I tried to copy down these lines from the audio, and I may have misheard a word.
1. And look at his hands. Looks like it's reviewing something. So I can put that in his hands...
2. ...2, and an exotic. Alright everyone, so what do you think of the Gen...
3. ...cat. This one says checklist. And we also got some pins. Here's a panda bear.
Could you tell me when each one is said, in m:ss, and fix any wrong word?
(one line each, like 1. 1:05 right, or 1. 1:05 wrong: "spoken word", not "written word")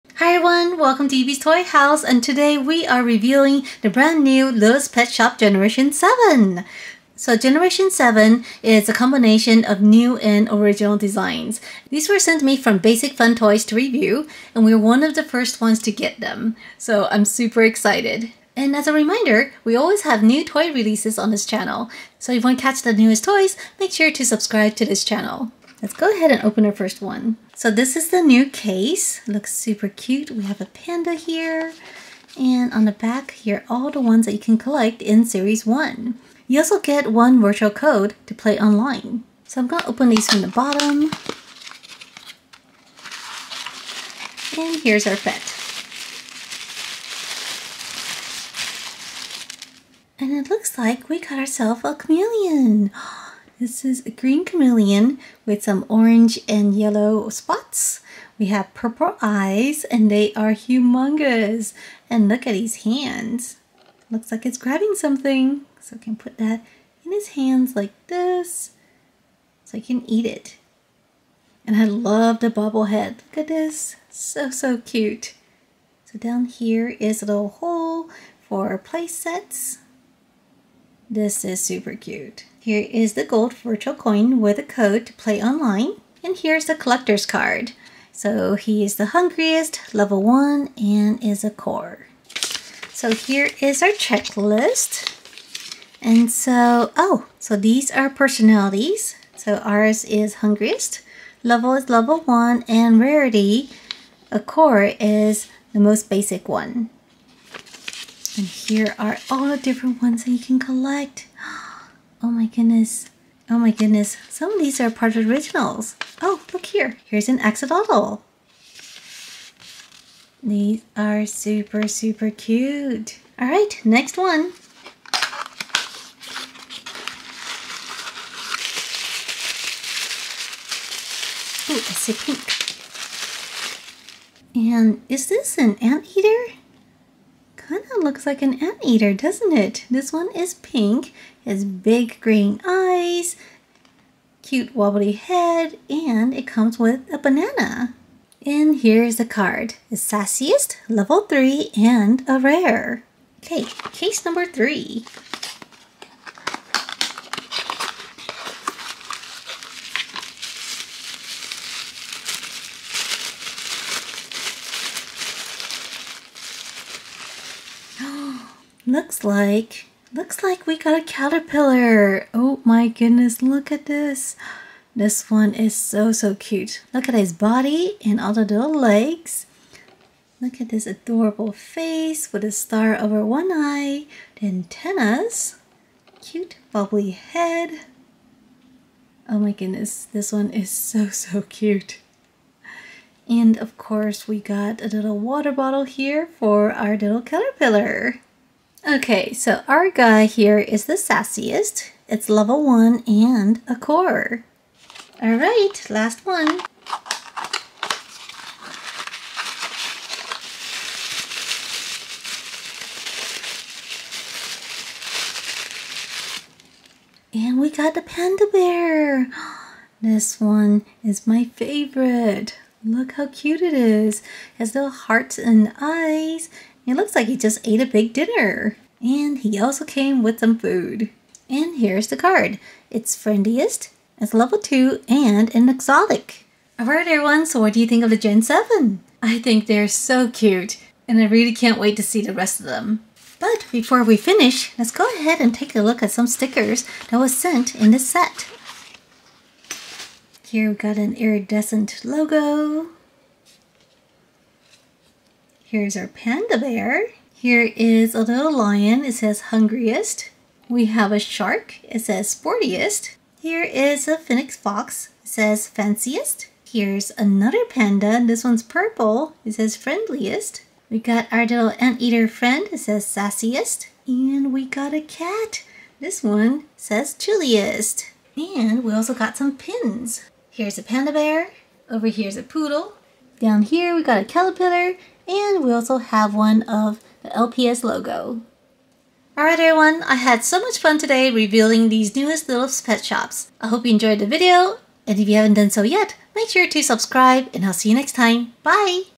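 1. 1:02 wrong: "grabbing", not "reviewing"
2. 3:54 right
3. 4:34 wrong: "chilliest", not "checklist".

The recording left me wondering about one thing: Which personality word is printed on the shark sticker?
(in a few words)
Sportiest.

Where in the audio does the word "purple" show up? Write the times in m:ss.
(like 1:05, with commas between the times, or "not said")
0:58, 4:28.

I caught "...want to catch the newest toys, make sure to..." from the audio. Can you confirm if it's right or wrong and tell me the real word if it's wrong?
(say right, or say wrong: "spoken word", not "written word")
right.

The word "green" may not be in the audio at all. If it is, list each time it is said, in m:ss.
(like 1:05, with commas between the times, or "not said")
0:54, 2:22.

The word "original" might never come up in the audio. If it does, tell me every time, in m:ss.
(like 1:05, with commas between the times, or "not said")
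0:10, 1:55.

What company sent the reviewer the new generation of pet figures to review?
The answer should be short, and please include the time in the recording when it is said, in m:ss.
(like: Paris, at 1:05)
Basic Fun Toys, at 0:12.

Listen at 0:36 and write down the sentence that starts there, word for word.
You also get one virtual code to play online.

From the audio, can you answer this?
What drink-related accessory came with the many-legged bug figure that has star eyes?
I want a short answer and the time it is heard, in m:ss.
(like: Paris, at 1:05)
Water bottle, at 3:15.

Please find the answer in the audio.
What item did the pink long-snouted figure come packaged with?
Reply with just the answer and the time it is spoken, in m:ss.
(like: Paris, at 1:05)
A banana, at 2:27.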